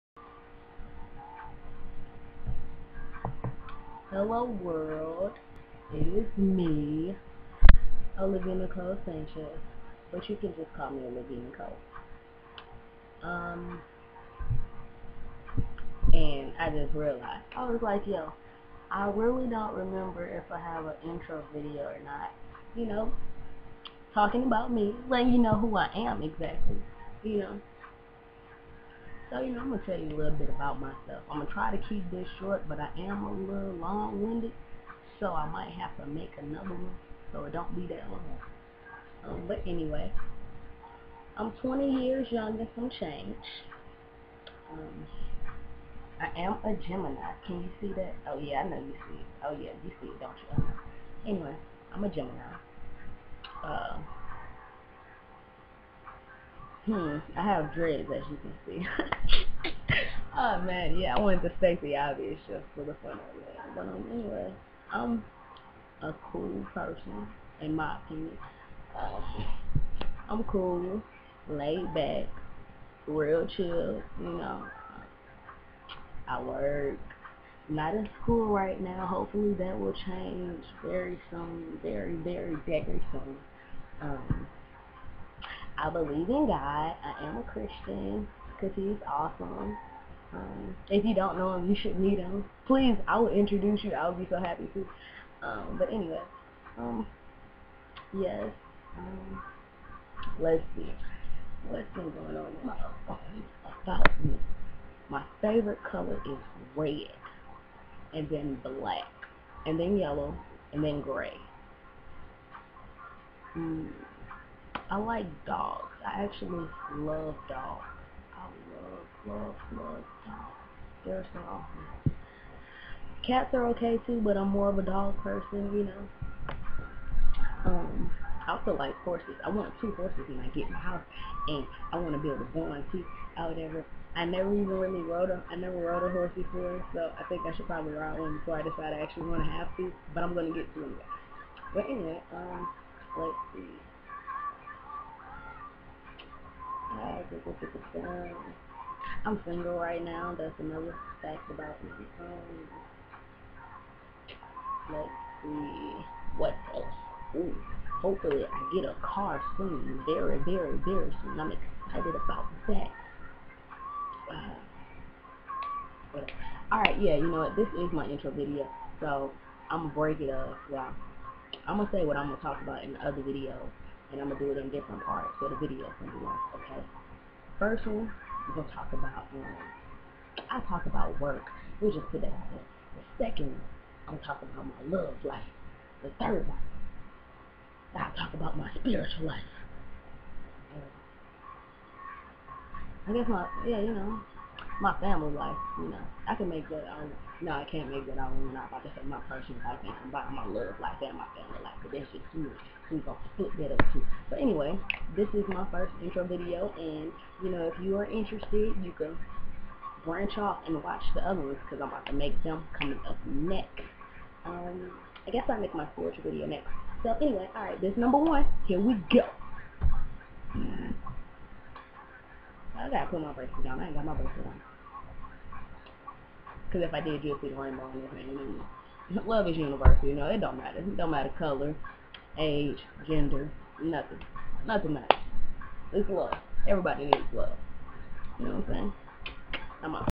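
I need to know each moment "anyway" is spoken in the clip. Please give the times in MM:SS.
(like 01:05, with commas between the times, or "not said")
00:39, 00:51, 01:04, 01:35, 02:21, 03:24, 03:37.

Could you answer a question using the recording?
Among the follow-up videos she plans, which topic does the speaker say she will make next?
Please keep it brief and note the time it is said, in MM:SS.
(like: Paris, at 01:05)
Spiritual life, at 03:35.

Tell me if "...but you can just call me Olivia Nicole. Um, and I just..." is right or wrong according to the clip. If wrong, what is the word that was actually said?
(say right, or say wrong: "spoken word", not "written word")
right.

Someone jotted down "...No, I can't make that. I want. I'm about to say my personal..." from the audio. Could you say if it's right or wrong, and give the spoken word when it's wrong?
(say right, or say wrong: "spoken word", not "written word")
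right.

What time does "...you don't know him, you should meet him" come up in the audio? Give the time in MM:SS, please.
01:31.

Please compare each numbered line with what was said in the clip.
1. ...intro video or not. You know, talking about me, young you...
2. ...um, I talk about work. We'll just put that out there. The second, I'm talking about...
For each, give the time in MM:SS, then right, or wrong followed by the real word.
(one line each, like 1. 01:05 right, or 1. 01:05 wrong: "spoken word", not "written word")
1. 00:21 wrong: "letting", not "young"
2. 02:59 right.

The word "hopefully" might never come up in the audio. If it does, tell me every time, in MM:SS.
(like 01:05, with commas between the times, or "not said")
01:19, 02:38.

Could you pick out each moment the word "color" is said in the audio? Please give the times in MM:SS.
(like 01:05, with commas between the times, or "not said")
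01:45, 03:51.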